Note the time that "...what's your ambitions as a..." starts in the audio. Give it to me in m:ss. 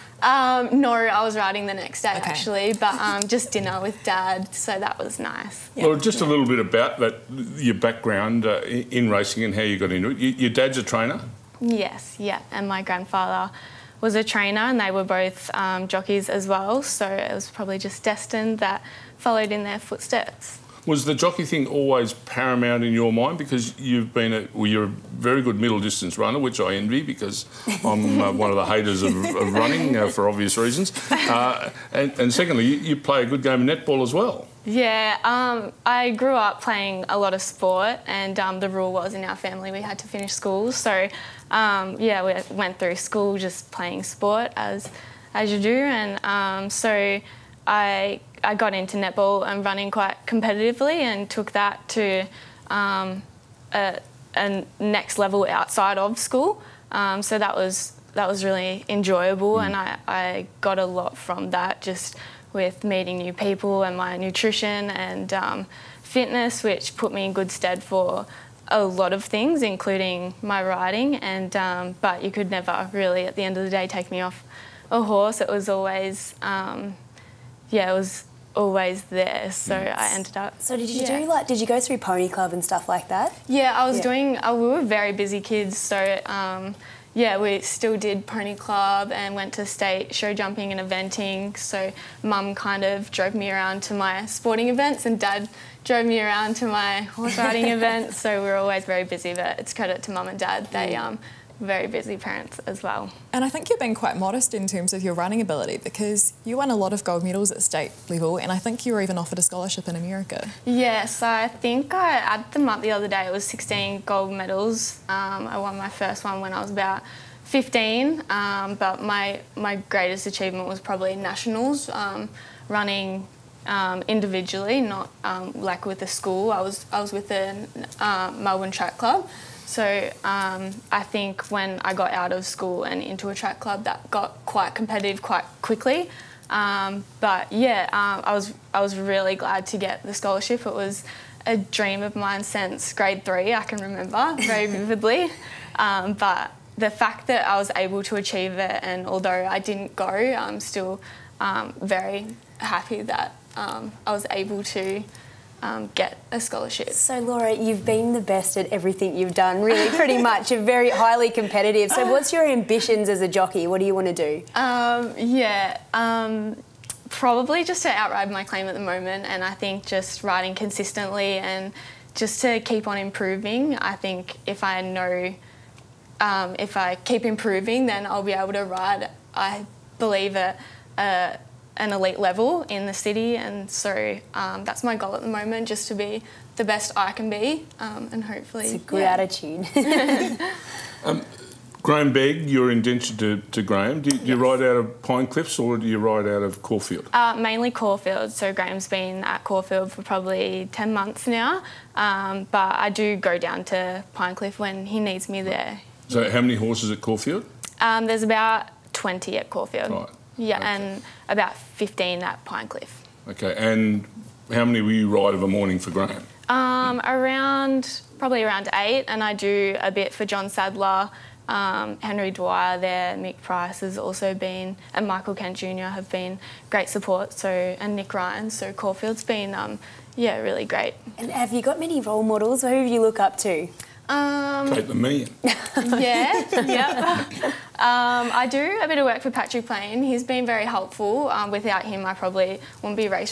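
2:42.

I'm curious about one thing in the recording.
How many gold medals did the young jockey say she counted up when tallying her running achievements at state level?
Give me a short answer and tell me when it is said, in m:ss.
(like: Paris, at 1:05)
16, at 1:53.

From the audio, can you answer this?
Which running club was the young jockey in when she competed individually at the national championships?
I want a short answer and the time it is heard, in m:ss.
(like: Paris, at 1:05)
Melbourne Track Club, at 2:08.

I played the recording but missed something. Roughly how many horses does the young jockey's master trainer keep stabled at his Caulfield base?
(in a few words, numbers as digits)
20.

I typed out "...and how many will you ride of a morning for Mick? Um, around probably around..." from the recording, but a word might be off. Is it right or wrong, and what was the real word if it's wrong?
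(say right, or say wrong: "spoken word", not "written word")
wrong: "Graham", not "Mick".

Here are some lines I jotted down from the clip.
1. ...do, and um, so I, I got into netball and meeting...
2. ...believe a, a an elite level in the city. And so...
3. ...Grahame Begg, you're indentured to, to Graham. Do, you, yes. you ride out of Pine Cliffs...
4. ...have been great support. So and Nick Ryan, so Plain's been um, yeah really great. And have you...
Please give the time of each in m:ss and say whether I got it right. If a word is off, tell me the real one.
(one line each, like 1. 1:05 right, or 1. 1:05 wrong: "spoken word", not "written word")
1. 0:45 wrong: "running", not "meeting"
2. 2:59 right
3. 3:11 right
4. 3:45 wrong: "Caulfield", not "Plain".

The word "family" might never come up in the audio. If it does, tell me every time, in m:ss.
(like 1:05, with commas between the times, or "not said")
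0:39.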